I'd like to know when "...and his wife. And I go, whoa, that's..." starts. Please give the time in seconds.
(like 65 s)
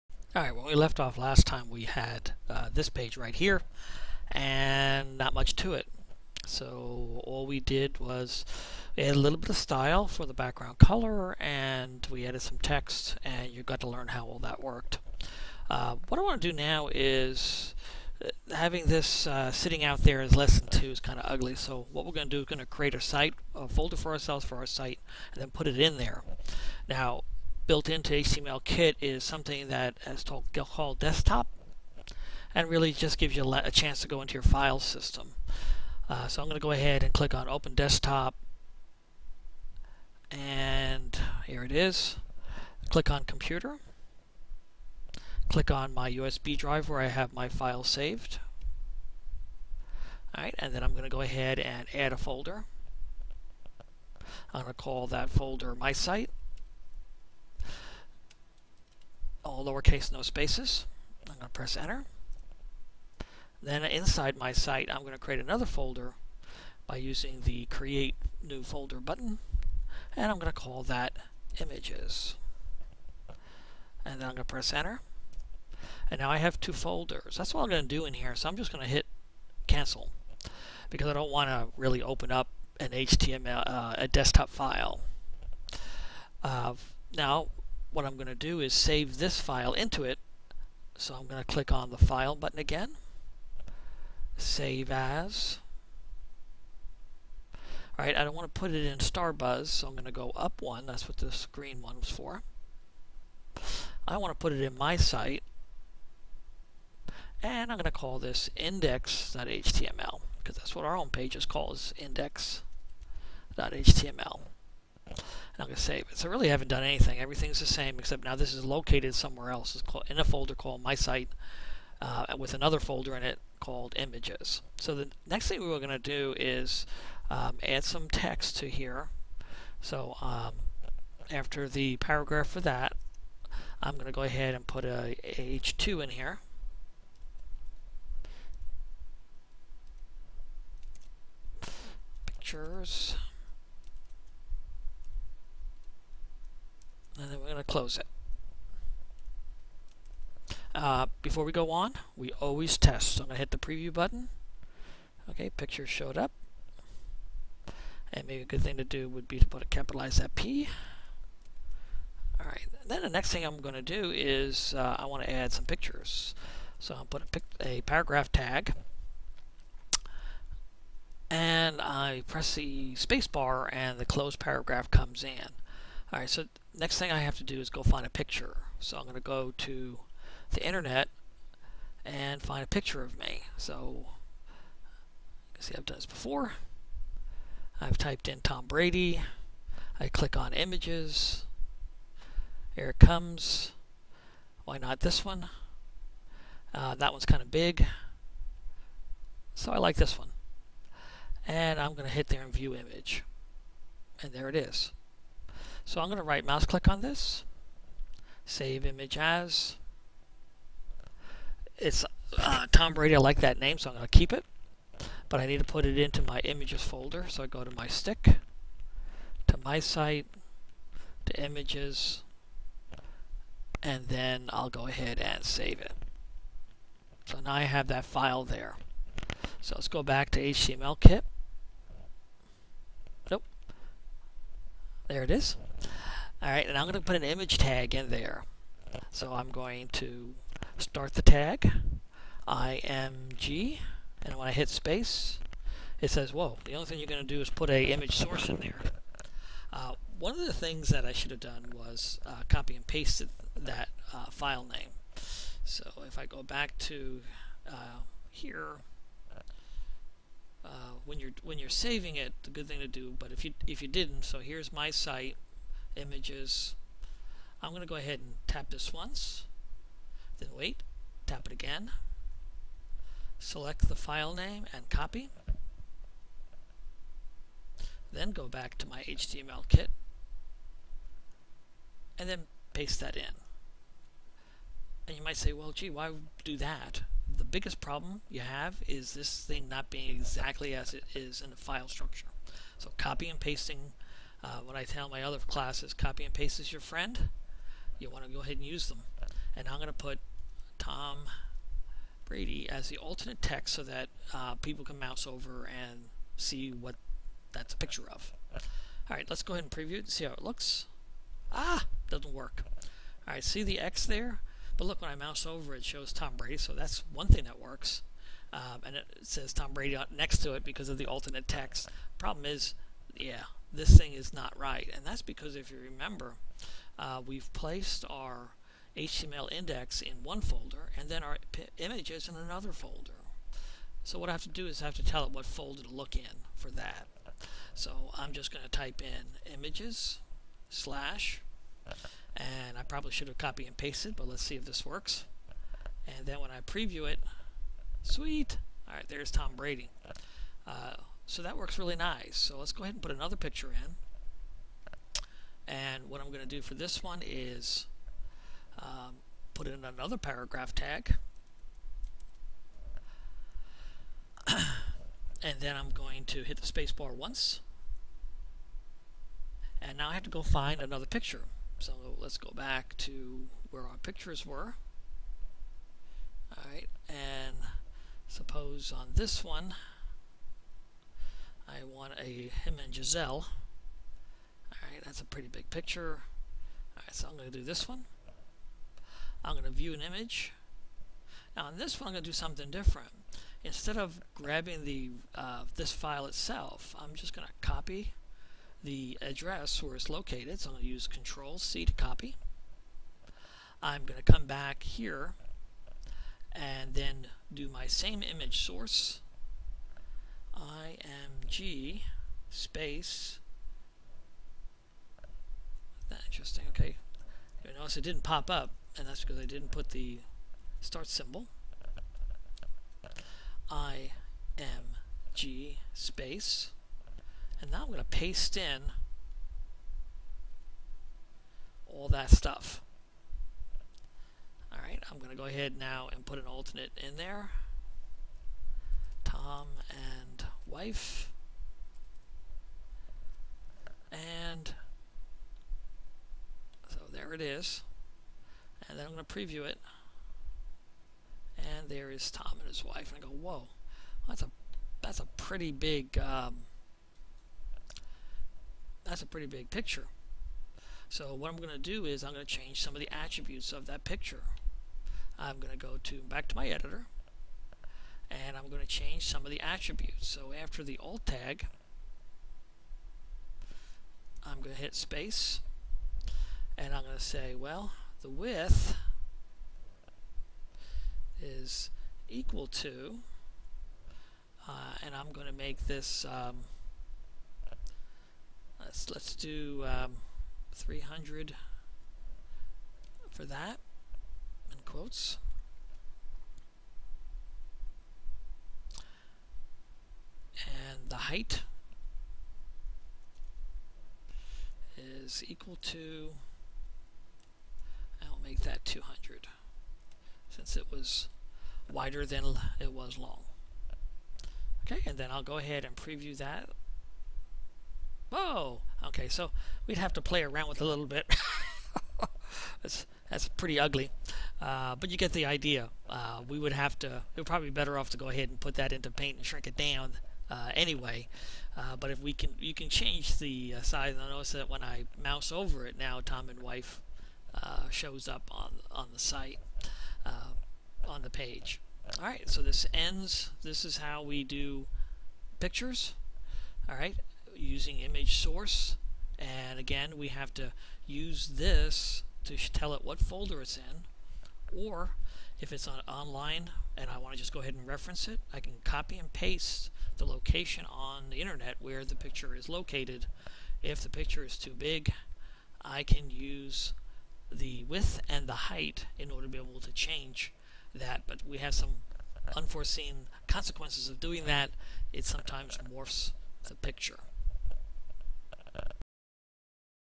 452 s.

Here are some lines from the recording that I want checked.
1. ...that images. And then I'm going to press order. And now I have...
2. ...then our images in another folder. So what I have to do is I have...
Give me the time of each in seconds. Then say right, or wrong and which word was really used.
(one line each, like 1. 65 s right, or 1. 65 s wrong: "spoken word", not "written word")
1. 70 s wrong: "enter", not "order"
2. 331 s right.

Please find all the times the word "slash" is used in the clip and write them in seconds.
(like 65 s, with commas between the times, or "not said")
340 s.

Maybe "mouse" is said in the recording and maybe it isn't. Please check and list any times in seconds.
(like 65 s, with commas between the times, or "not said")
206 s, 304 s, 315 s, 535 s.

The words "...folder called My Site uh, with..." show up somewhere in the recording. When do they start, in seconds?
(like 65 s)
120 s.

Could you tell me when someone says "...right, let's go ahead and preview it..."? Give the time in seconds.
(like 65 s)
309 s.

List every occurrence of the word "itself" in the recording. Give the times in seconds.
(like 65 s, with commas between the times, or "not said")
396 s.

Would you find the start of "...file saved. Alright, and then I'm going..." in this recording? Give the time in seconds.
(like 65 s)
47 s.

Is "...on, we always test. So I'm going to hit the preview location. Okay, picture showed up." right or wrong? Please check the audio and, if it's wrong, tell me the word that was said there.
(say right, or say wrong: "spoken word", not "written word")
wrong: "button", not "location".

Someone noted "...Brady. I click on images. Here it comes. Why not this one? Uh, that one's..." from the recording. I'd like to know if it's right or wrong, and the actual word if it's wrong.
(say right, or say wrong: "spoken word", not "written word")
right.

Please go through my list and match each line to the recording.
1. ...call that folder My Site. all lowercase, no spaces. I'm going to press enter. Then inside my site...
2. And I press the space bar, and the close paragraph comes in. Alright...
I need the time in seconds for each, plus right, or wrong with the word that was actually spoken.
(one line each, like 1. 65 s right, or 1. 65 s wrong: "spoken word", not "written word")
1. 54 s right
2. 171 s right.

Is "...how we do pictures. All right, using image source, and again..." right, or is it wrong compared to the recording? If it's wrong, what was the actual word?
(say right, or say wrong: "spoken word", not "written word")
right.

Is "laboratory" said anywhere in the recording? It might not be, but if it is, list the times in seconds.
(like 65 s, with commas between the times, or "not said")
not said.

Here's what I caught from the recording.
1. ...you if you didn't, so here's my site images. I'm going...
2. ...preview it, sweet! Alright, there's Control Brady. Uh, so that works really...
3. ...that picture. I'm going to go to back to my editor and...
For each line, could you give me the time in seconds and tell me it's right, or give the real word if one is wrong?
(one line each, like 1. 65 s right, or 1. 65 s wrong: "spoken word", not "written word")
1. 263 s right
2. 346 s wrong: "Tom", not "Control"
3. 463 s right.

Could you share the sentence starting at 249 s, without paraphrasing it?
Uh, one of the things that I should have done was uh, copy and paste that uh, file name.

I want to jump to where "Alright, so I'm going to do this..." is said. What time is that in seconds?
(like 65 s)
386 s.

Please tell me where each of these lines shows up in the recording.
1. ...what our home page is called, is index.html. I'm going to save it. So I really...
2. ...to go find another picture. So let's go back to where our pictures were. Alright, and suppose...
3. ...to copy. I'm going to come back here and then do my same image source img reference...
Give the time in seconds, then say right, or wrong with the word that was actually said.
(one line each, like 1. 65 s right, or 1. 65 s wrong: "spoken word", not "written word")
1. 110 s right
2. 370 s right
3. 401 s wrong: "space", not "reference".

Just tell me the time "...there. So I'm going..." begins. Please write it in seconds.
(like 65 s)
238 s.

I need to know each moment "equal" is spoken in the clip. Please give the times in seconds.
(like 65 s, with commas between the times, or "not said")
482 s, 505 s.